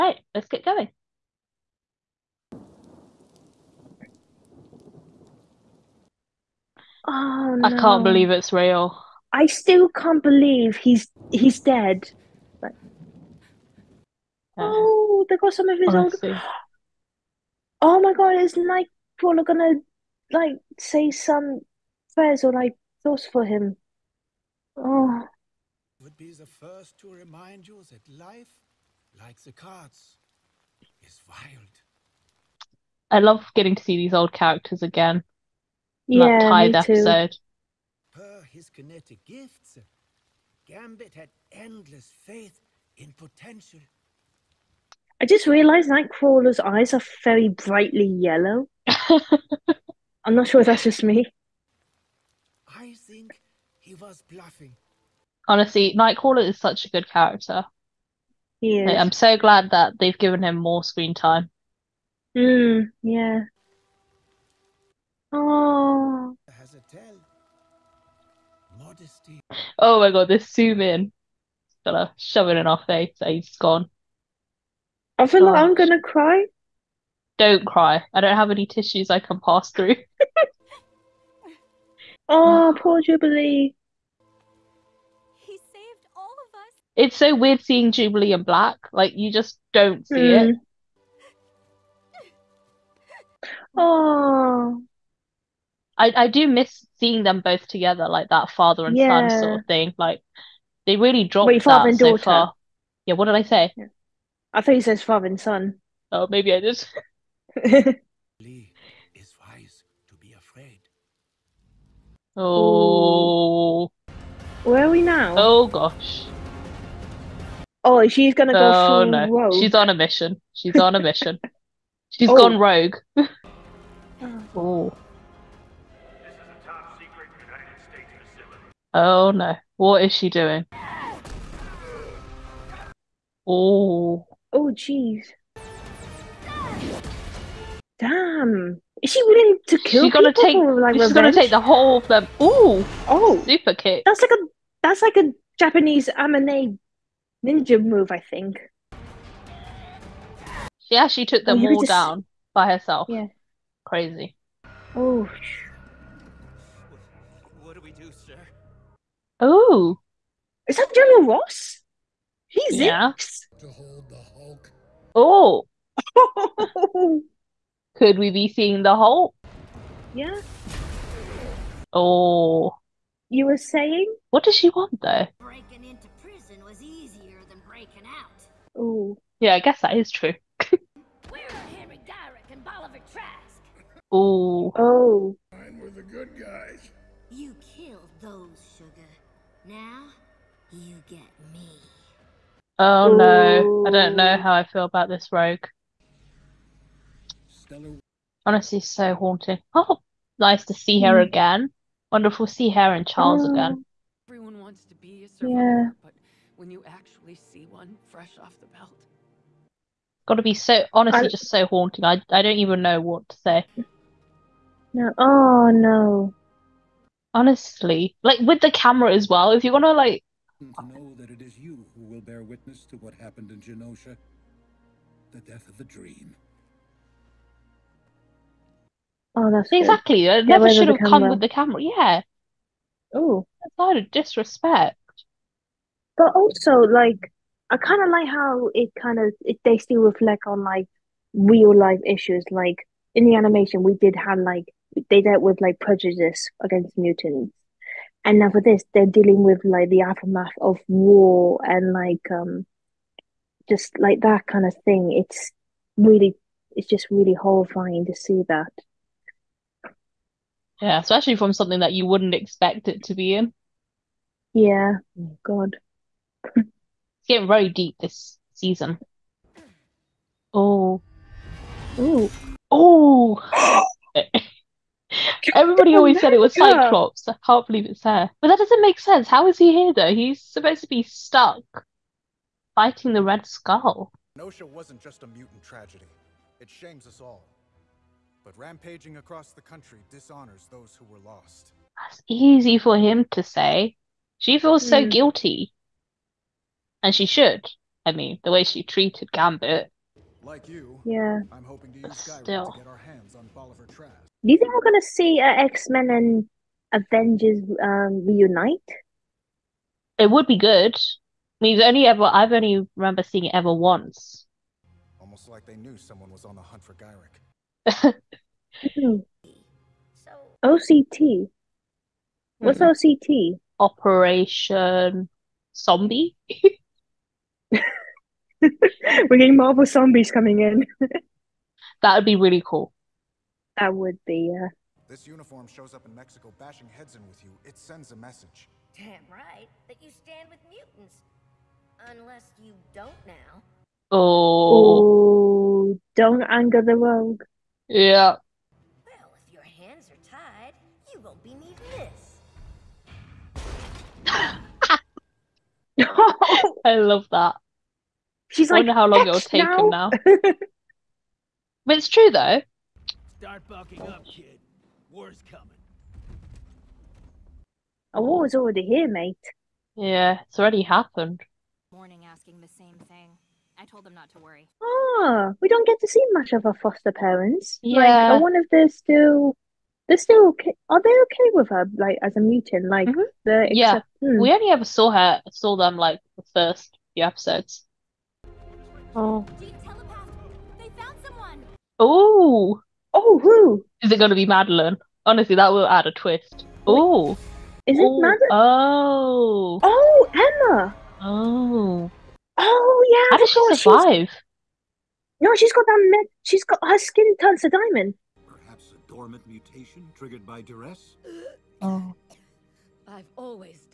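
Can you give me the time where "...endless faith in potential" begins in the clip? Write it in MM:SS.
00:41.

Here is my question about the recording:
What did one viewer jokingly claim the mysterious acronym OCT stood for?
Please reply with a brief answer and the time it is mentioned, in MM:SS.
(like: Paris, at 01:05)
Operation Zombie, at 05:23.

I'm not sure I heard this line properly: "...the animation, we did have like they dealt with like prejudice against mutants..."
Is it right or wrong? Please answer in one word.
right.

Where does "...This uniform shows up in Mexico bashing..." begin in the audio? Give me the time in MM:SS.
05:35.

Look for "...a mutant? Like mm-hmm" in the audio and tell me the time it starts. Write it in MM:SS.
06:22.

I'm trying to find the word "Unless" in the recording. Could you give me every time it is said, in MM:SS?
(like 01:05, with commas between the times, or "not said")
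05:42.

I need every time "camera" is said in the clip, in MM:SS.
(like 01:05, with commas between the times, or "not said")
03:38, 03:51.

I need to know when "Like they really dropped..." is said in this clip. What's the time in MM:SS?
01:39.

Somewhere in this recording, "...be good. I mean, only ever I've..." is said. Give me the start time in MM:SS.
05:10.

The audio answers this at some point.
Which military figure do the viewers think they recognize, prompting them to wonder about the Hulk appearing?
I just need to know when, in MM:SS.
02:40.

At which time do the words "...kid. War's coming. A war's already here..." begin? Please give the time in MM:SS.
06:04.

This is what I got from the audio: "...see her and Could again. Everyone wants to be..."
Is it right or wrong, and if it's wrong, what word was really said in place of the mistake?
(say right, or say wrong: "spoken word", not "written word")
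wrong: "Charles", not "Could".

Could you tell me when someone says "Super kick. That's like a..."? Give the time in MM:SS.
02:23.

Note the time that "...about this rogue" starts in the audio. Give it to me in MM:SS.
03:14.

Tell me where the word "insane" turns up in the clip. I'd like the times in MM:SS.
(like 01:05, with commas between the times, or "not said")
not said.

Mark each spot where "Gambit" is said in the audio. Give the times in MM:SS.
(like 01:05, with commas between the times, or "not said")
00:40, 04:59.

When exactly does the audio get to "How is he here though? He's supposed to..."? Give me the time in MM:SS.
04:39.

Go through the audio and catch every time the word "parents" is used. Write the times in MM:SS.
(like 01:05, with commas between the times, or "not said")
06:17.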